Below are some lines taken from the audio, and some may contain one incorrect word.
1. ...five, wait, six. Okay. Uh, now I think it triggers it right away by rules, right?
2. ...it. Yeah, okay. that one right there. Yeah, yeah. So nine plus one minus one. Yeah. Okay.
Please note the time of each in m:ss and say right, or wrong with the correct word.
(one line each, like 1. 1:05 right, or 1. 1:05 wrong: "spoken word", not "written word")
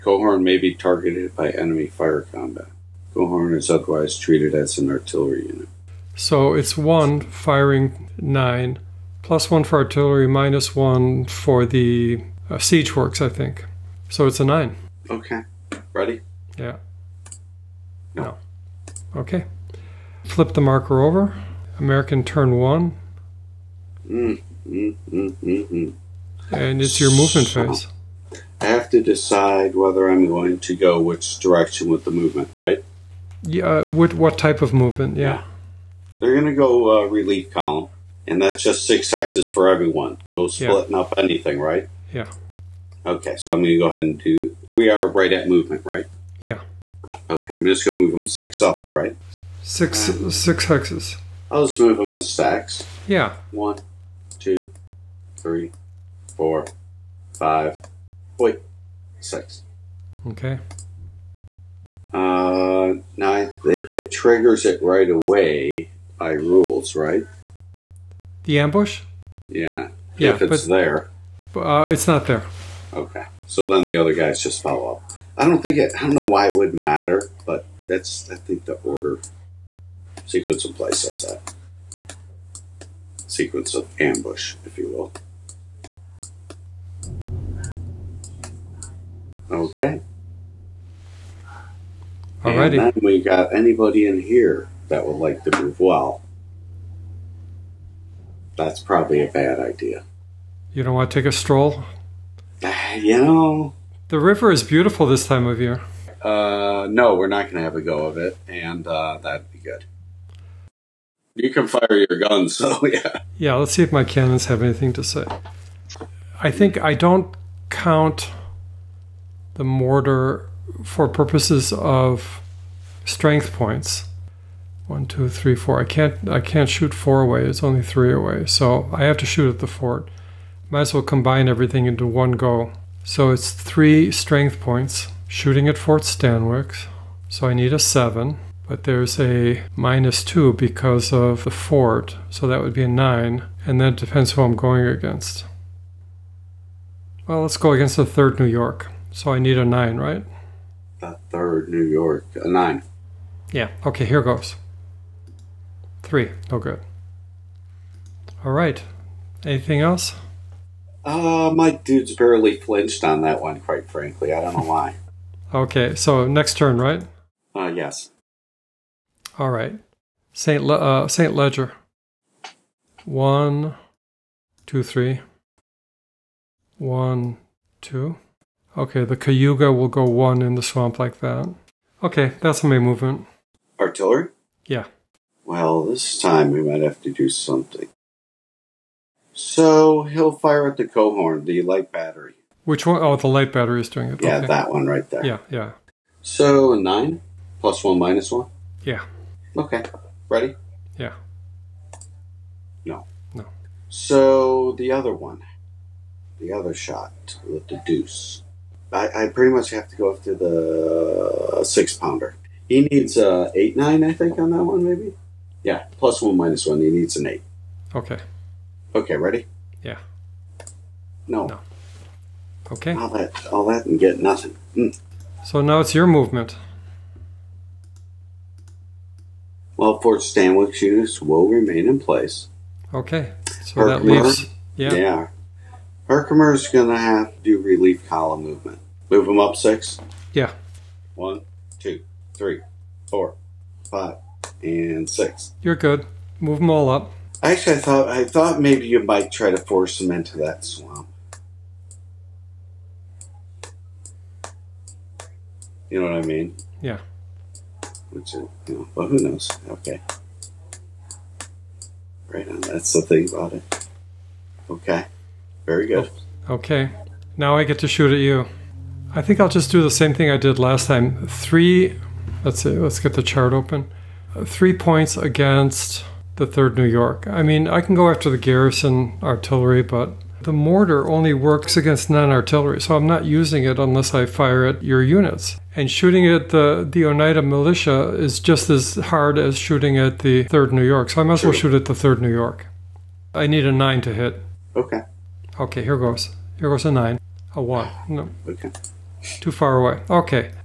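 1. 0:57 right
2. 3:14 right.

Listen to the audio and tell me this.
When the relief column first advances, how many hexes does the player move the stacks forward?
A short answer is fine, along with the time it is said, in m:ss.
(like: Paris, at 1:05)
6, at 0:50.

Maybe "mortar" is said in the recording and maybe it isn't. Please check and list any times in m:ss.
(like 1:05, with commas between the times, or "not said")
1:59, 4:40.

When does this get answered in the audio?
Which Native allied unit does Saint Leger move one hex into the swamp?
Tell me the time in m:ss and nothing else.
2:59.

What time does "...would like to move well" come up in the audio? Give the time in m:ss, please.
1:35.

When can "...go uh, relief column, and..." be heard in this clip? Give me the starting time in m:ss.
0:36.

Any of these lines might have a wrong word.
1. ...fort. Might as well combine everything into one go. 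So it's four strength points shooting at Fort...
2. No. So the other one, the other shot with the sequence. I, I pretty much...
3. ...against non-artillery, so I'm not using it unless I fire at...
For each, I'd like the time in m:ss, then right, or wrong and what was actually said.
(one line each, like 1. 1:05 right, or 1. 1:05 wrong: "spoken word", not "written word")
1. 2:09 wrong: "three", not "four"
2. 3:23 wrong: "deuce", not "sequence"
3. 4:41 right.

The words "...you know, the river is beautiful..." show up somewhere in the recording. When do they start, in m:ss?
1:42.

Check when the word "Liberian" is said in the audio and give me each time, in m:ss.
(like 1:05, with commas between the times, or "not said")
not said.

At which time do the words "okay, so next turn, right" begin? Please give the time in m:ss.
2:45.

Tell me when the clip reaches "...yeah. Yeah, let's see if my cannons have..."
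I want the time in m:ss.
1:52.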